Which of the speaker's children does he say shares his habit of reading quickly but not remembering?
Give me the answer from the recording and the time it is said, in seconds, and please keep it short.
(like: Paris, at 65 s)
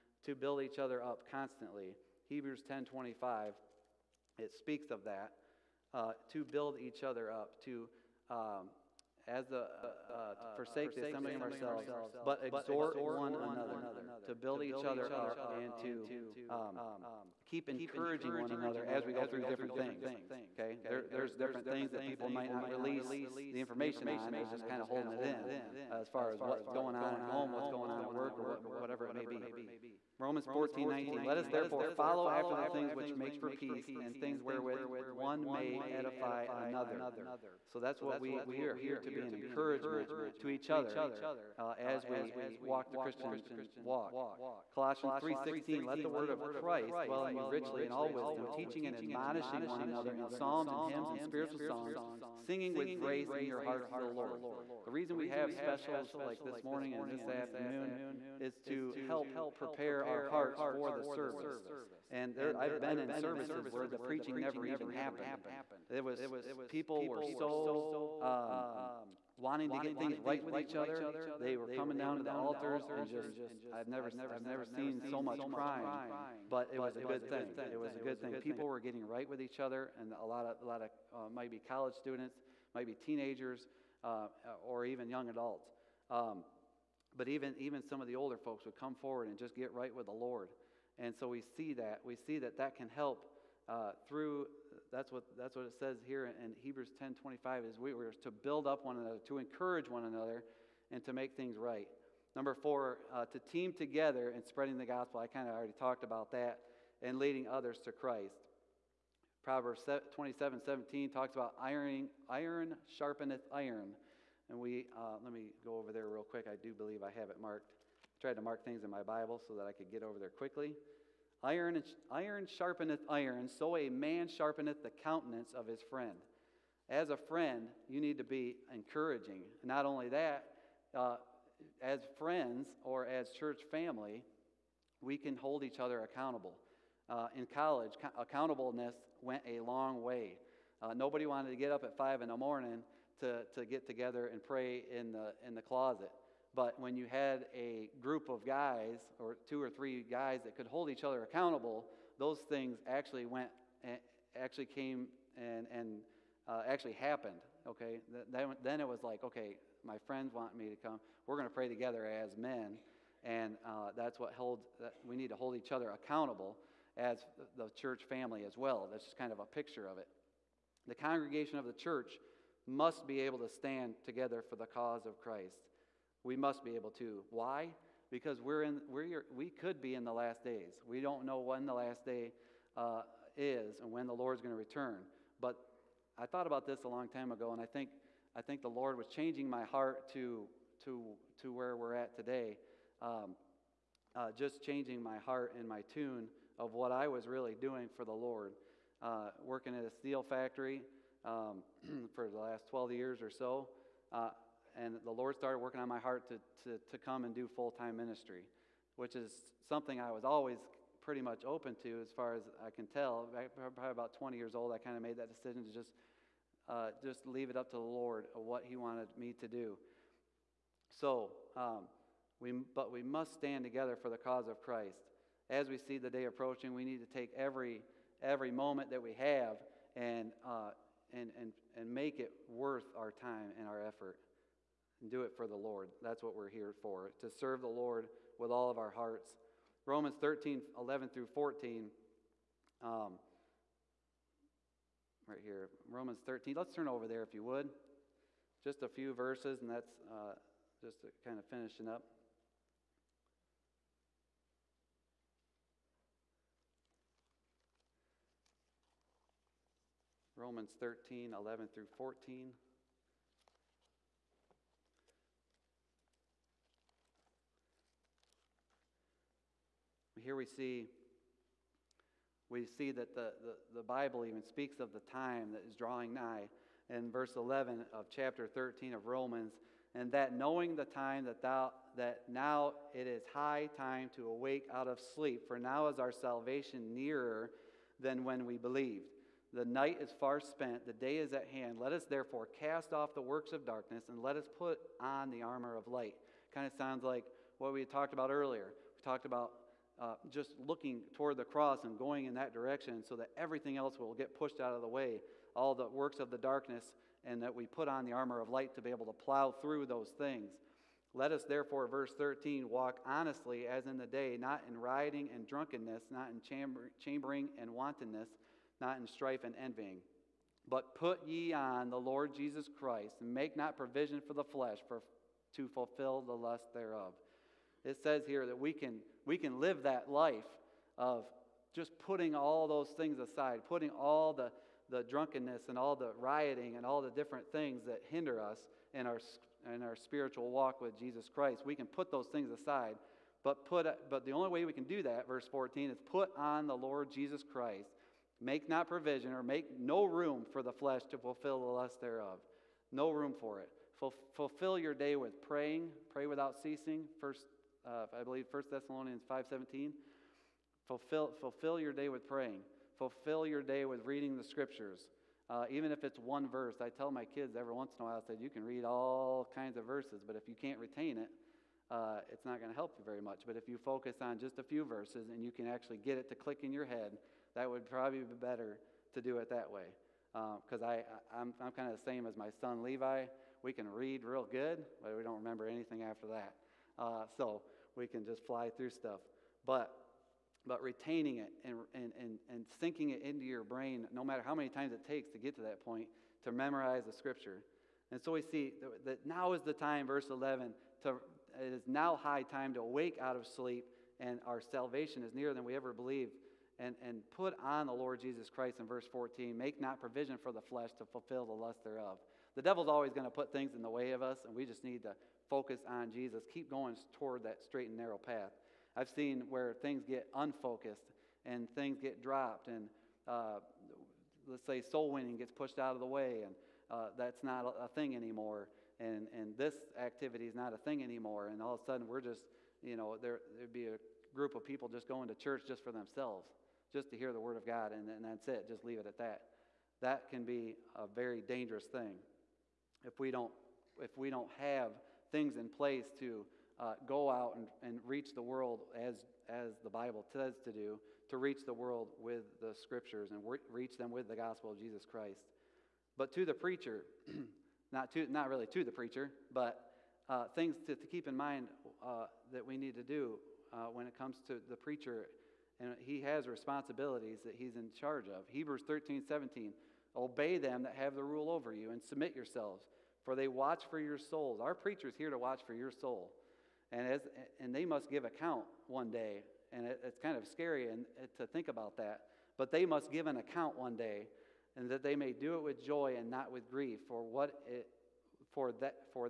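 Levi, at 382 s.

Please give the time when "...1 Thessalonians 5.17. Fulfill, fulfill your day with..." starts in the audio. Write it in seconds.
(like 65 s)
358 s.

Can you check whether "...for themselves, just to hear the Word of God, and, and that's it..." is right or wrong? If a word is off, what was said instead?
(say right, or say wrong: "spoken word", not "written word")
right.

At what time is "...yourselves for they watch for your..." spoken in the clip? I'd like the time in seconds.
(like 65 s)
472 s.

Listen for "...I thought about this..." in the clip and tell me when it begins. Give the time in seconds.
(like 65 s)
186 s.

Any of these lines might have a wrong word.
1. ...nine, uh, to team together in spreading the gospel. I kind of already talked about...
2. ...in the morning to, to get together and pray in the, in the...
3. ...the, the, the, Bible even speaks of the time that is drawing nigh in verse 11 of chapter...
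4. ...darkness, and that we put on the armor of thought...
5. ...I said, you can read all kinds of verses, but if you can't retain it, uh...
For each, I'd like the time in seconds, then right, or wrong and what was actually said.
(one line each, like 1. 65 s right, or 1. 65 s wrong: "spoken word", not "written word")
1. 102 s wrong: "four", not "nine"
2. 142 s right
3. 273 s right
4. 306 s wrong: "light", not "thought"
5. 368 s right.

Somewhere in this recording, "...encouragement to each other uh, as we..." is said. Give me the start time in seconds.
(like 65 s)
39 s.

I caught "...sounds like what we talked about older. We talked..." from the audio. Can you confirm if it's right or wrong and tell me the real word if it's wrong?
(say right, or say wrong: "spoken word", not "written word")
wrong: "earlier", not "older".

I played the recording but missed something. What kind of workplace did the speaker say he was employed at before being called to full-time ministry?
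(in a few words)
steel factory.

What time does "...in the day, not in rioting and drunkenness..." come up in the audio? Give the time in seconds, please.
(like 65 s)
313 s.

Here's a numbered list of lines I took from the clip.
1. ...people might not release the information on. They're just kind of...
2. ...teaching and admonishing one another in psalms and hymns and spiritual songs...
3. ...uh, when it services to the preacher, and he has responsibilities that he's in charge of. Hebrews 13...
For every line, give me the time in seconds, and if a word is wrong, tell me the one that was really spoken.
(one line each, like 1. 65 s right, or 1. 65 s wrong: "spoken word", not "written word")
1. 22 s right
2. 48 s right
3. 463 s wrong: "comes", not "services".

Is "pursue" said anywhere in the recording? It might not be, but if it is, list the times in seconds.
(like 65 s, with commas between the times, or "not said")
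not said.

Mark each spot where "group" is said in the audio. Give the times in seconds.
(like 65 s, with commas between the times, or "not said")
147 s, 434 s.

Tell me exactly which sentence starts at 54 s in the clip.
The reason we have specials like this morning and this afternoon is to help prepare our hearts for the service.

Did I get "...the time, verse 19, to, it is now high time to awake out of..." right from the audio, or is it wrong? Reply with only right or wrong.
wrong.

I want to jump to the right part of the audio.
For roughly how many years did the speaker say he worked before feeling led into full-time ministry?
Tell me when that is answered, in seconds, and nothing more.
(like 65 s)
202 s.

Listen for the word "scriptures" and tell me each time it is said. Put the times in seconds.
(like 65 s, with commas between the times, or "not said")
364 s, 397 s, 452 s.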